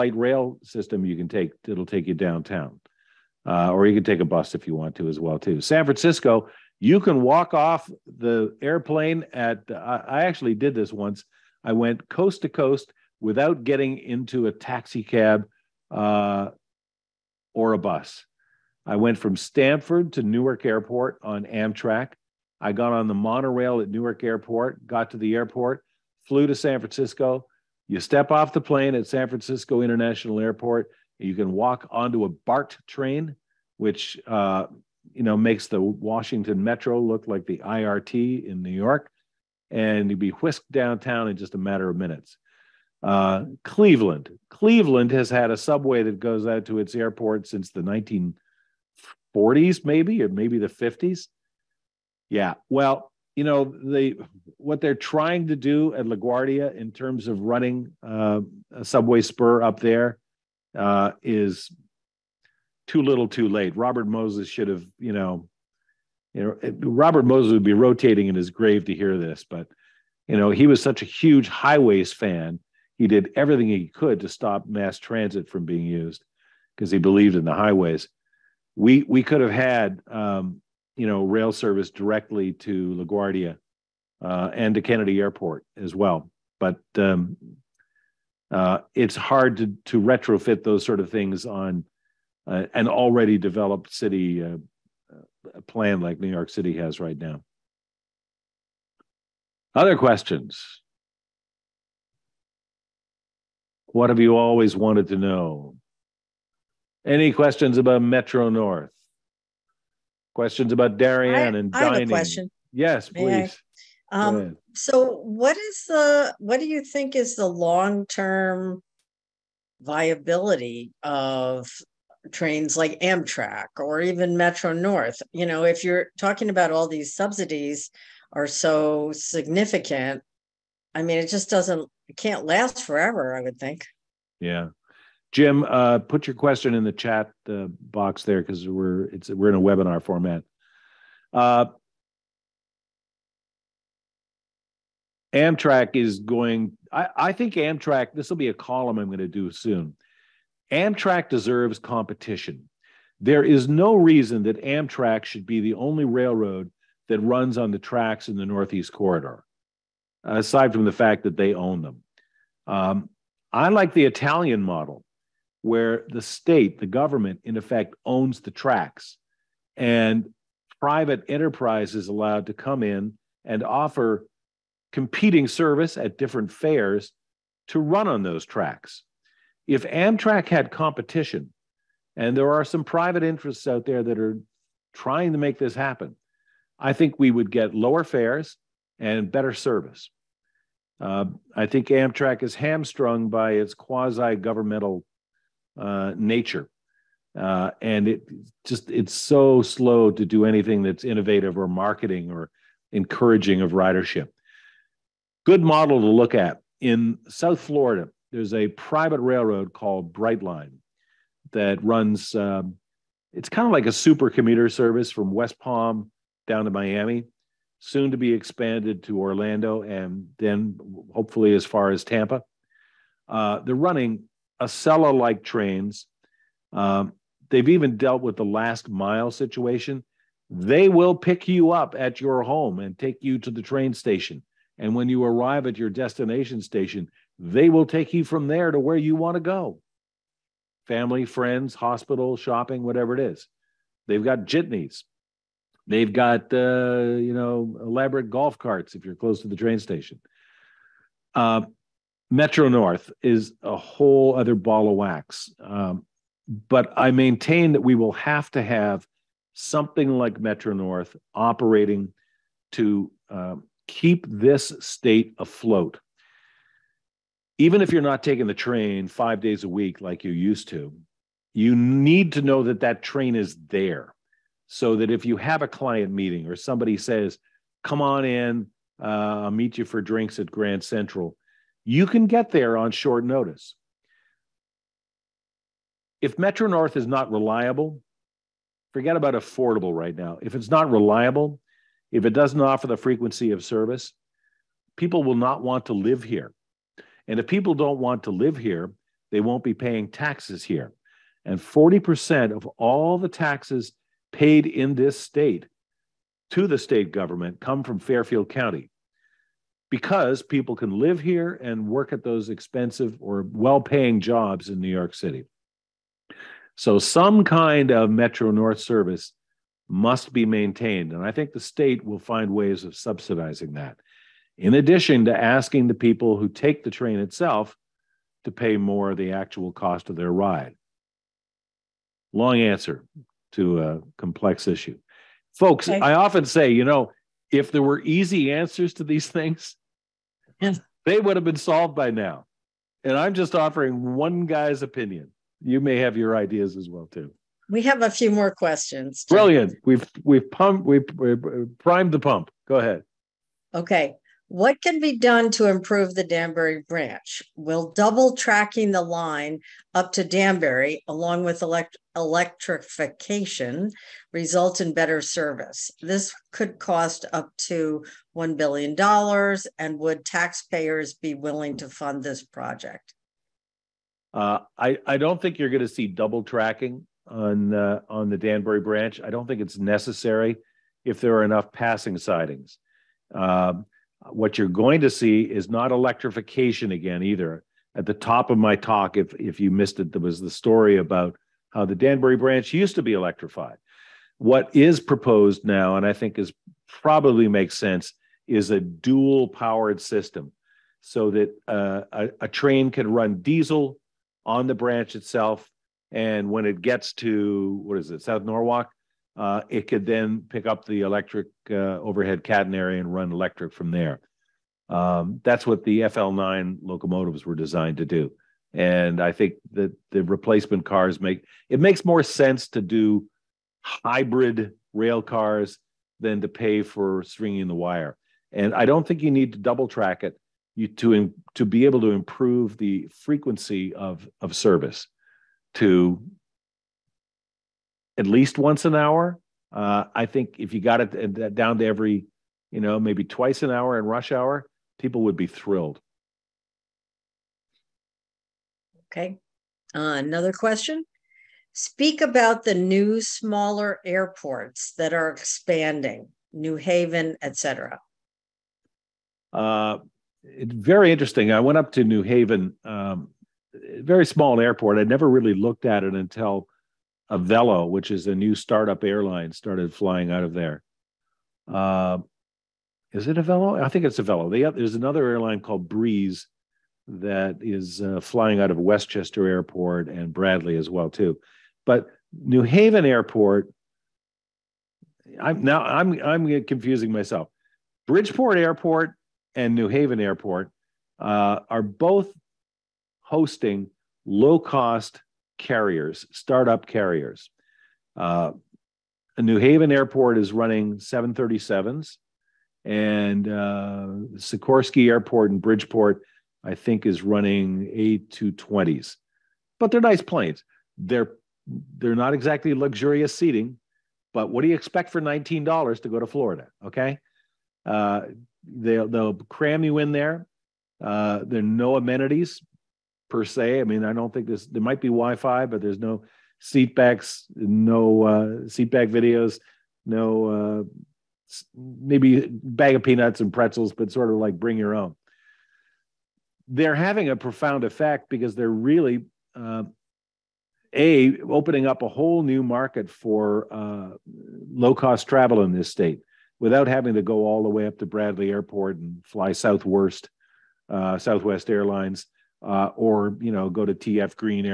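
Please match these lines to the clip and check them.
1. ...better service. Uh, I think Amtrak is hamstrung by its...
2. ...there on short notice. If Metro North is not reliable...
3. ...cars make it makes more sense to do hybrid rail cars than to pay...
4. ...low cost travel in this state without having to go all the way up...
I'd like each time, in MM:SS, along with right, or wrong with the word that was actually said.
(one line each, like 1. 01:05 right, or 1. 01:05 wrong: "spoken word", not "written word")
1. 03:09 right
2. 04:42 right
3. 07:00 right
4. 09:04 right.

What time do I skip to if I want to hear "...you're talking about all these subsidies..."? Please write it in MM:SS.
02:05.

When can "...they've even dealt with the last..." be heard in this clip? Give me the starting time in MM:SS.
03:47.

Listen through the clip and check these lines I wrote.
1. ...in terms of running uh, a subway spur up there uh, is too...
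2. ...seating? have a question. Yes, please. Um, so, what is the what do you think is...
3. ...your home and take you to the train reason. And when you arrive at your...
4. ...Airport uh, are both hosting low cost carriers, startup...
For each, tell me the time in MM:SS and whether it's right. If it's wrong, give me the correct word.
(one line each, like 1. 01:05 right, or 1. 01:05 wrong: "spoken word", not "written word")
1. 00:56 right
2. 01:51 wrong: "dining", not "seating"
3. 03:52 wrong: "station", not "reason"
4. 08:10 right.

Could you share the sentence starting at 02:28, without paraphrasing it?
This will be a column I'm going to do soon.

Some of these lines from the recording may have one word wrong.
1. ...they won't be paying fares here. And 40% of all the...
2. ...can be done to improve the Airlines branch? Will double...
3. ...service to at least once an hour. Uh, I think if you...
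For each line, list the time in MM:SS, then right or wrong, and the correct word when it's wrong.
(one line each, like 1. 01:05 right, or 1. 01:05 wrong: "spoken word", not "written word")
1. 04:59 wrong: "taxes", not "fares"
2. 05:54 wrong: "Danbury", not "Airlines"
3. 07:14 right.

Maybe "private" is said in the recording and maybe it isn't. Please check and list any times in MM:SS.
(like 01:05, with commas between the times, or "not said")
02:50, 03:02, 03:28.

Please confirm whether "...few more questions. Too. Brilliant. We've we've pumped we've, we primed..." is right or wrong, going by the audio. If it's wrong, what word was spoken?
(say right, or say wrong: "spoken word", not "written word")
right.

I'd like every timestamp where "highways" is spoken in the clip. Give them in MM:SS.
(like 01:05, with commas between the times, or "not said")
01:11, 01:17.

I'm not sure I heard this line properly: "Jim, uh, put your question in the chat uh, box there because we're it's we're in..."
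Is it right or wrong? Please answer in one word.
right.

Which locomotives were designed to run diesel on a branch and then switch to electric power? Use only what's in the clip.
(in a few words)
FL9.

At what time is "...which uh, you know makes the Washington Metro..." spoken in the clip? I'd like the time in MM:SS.
00:33.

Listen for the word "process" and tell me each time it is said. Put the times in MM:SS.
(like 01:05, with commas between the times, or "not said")
not said.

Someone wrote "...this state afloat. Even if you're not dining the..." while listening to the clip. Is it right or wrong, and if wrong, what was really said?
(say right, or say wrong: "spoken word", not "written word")
wrong: "taking", not "dining".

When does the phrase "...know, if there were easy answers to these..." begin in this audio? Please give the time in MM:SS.
05:36.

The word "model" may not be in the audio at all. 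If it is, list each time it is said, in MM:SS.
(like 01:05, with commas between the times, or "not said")
02:44, 03:25.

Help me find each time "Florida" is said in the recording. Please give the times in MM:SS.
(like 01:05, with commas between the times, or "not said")
03:27, 08:36.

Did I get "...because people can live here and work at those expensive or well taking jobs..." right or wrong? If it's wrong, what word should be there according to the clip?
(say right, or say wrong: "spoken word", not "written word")
wrong: "paying", not "taking".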